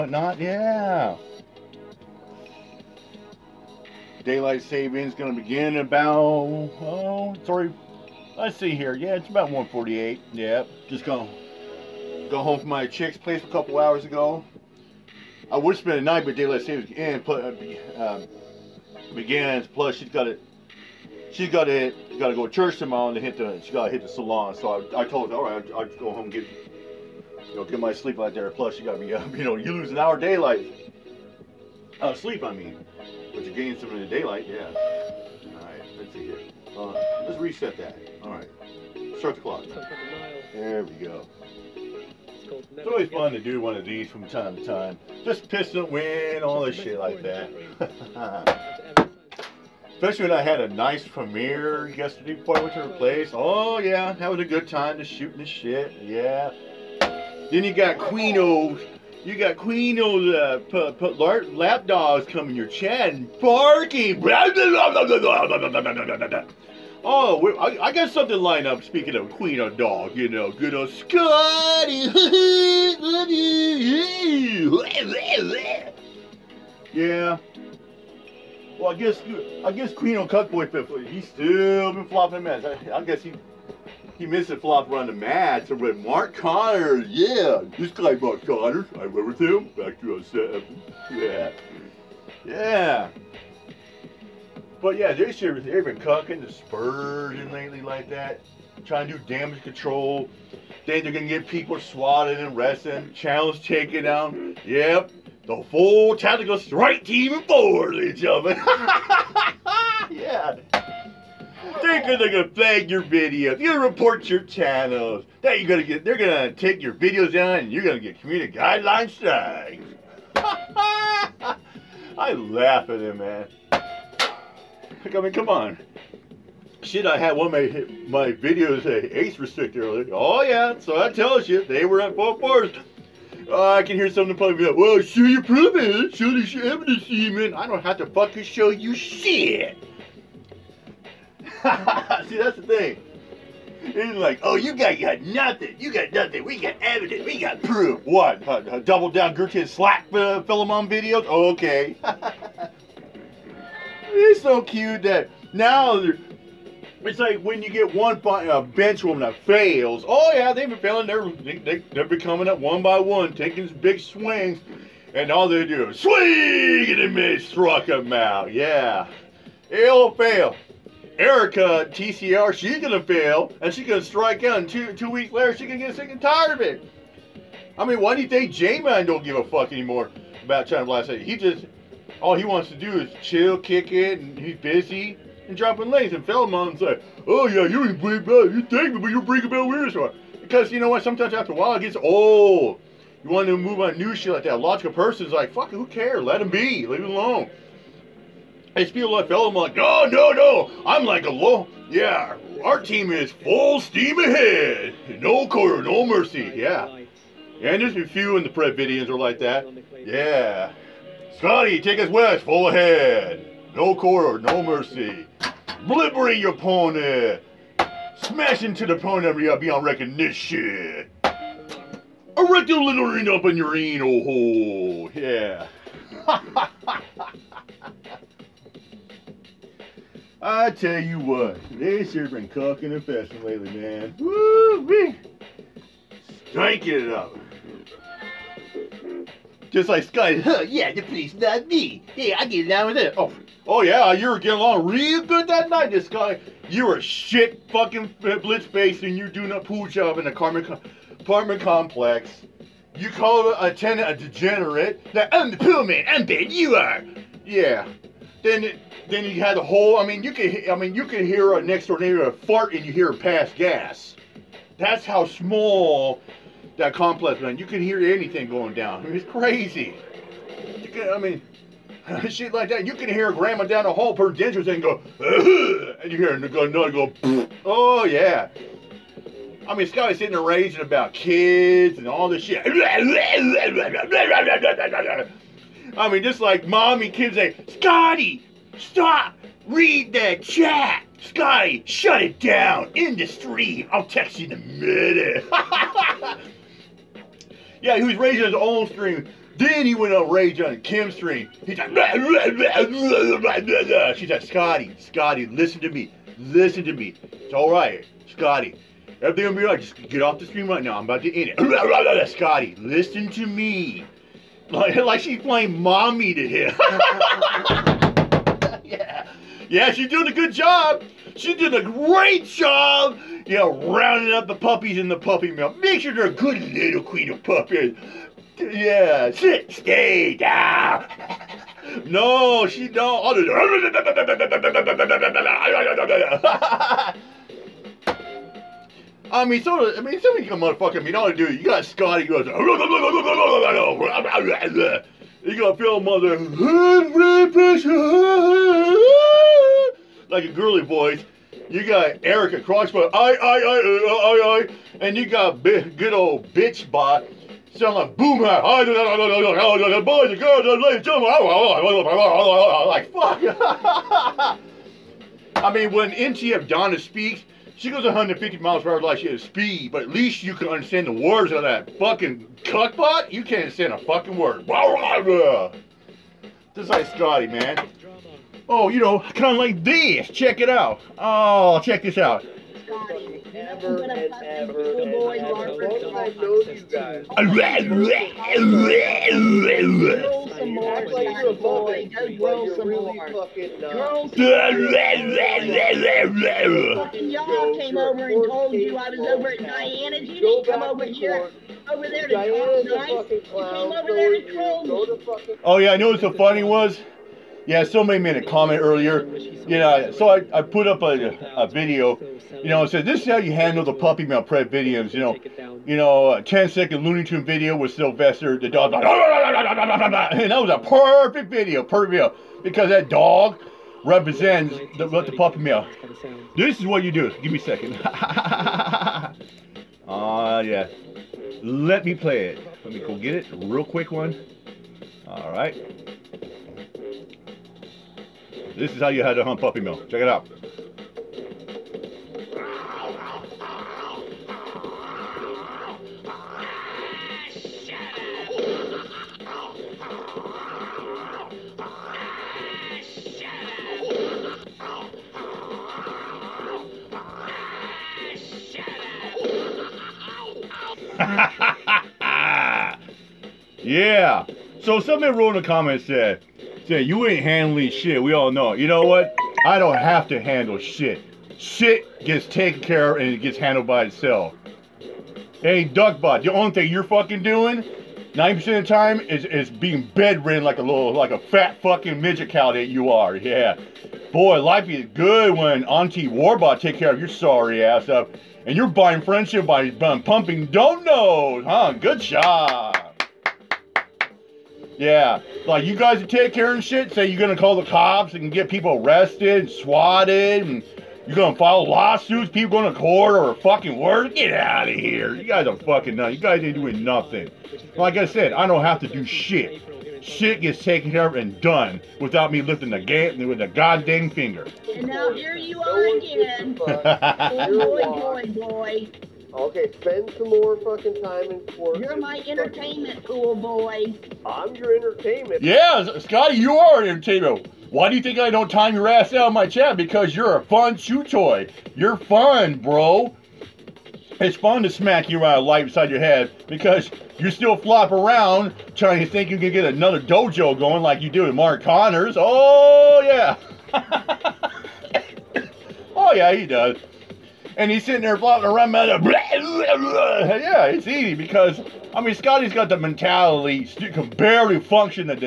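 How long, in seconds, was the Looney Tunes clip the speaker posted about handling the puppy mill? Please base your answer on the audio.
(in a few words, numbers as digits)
10.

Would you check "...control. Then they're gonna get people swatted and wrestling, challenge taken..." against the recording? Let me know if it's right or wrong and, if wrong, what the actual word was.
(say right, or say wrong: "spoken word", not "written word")
right.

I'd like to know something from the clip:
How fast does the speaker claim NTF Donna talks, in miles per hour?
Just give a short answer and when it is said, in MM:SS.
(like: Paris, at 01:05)
150, at 06:08.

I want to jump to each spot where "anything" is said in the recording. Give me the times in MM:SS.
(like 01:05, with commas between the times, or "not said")
04:28.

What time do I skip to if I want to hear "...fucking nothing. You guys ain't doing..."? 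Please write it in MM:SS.
08:25.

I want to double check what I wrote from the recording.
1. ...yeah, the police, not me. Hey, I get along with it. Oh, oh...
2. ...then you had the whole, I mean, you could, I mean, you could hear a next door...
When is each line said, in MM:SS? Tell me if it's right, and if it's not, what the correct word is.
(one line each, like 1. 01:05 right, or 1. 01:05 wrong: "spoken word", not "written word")
1. 04:00 right
2. 04:19 right.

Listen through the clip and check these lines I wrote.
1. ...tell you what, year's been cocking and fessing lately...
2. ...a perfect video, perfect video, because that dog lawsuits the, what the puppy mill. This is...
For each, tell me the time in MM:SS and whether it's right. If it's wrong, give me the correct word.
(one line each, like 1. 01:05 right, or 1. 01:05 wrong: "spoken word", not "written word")
1. 03:50 right
2. 07:00 wrong: "represents", not "lawsuits".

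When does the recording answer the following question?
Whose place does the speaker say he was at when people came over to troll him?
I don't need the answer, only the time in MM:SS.
06:39.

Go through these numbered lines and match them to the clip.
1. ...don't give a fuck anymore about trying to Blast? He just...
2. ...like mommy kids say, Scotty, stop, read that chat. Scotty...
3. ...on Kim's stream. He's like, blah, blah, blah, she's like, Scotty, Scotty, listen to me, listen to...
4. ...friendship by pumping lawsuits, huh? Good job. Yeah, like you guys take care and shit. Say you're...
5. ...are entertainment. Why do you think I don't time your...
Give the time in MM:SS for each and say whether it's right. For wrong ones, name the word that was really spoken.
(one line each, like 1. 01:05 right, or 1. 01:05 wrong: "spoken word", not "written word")
1. 02:59 right
2. 04:46 right
3. 05:00 right
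4. 08:09 wrong: "donuts", not "lawsuits"
5. 08:46 right.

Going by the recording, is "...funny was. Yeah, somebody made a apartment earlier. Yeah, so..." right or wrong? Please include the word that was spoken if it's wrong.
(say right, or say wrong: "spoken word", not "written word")
wrong: "comment", not "apartment".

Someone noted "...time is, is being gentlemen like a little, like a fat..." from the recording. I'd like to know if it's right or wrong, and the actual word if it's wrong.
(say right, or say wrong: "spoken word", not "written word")
wrong: "bedridden", not "gentlemen".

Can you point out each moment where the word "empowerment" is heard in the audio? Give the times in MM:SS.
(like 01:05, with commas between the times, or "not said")
not said.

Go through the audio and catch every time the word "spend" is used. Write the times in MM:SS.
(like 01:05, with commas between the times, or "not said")
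00:15, 08:39.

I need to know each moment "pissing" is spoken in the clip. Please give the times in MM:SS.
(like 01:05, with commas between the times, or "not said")
00:45.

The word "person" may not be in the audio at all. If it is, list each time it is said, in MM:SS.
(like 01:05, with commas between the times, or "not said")
03:14.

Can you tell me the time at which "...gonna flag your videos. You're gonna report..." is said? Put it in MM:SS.
01:52.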